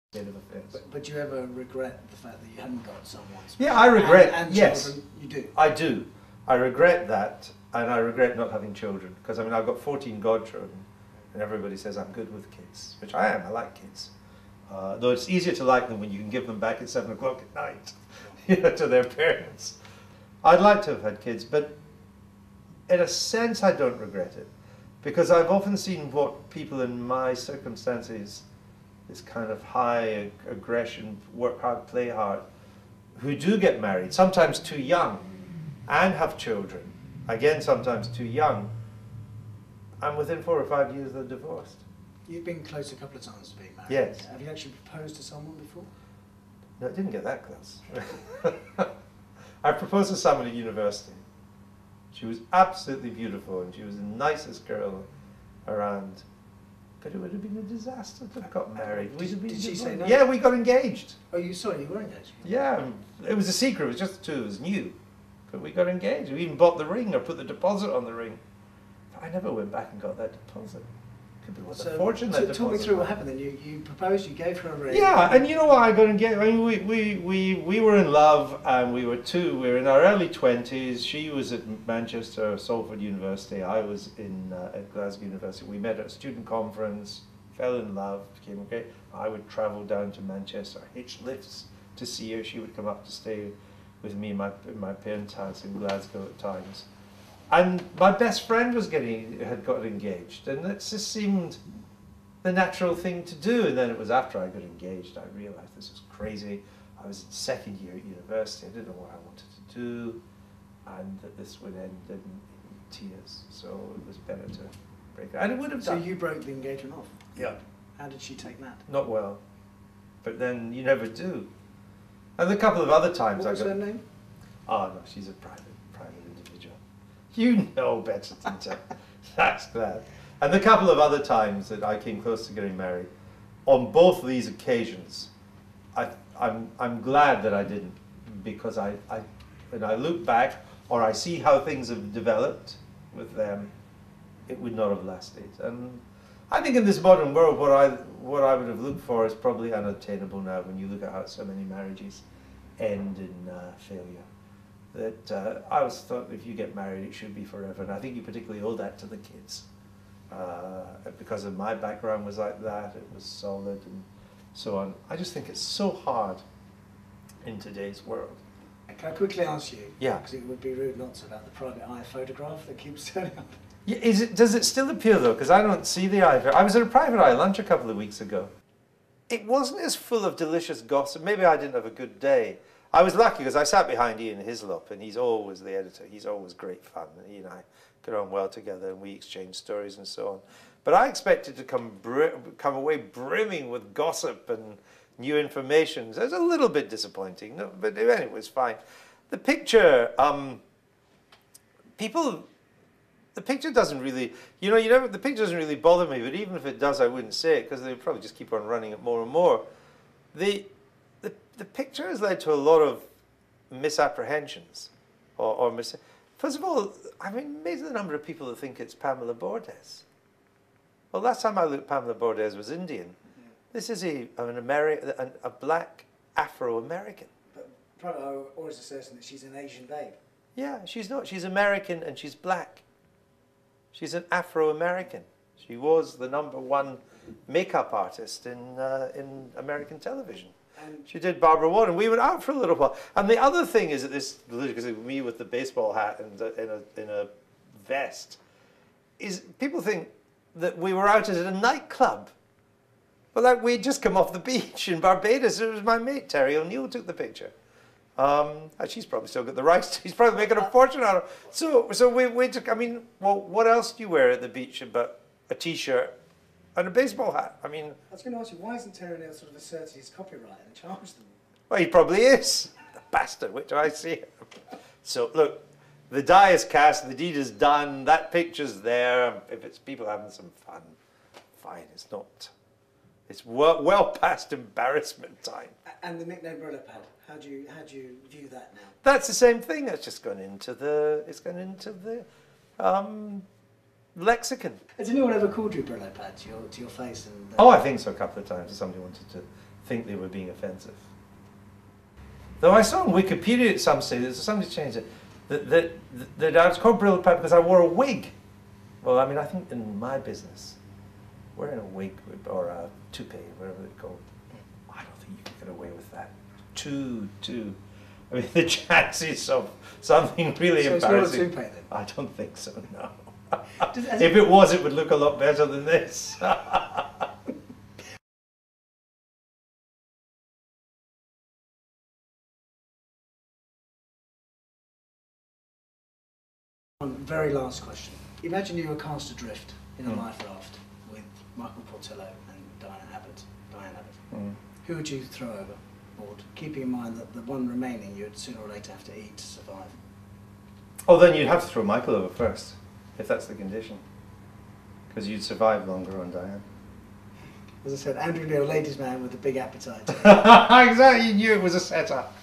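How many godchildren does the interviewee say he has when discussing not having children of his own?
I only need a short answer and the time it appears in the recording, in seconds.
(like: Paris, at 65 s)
14, at 9 s.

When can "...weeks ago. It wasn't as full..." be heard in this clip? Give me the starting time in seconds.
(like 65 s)
177 s.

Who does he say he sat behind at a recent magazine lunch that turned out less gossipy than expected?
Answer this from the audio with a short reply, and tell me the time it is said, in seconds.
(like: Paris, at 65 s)
Ian Hislop, at 184 s.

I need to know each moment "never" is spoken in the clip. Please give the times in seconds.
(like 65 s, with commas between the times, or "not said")
69 s, 120 s.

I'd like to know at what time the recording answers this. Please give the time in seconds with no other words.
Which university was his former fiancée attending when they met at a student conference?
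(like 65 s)
81 s.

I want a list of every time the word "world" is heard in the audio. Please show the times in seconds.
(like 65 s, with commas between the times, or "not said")
147 s, 168 s.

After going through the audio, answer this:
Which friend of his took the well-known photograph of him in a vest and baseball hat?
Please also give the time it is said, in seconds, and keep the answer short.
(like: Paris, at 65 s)
Terry O'Neill, at 256 s.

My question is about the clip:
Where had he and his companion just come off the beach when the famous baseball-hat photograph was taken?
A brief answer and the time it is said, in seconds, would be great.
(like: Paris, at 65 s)
Barbados, at 254 s.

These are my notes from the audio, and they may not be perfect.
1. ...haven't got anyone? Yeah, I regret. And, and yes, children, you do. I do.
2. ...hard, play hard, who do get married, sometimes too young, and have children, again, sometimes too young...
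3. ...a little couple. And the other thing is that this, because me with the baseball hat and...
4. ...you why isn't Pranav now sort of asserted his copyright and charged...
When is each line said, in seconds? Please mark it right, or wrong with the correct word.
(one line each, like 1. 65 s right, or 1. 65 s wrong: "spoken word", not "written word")
1. 2 s wrong: "someone", not "anyone"
2. 31 s right
3. 242 s wrong: "while", not "couple"
4. 268 s wrong: "Terry", not "Pranav".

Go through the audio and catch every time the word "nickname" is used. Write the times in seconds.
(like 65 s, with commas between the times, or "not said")
286 s.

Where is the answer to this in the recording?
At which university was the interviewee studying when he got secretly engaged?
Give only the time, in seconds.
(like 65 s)
84 s.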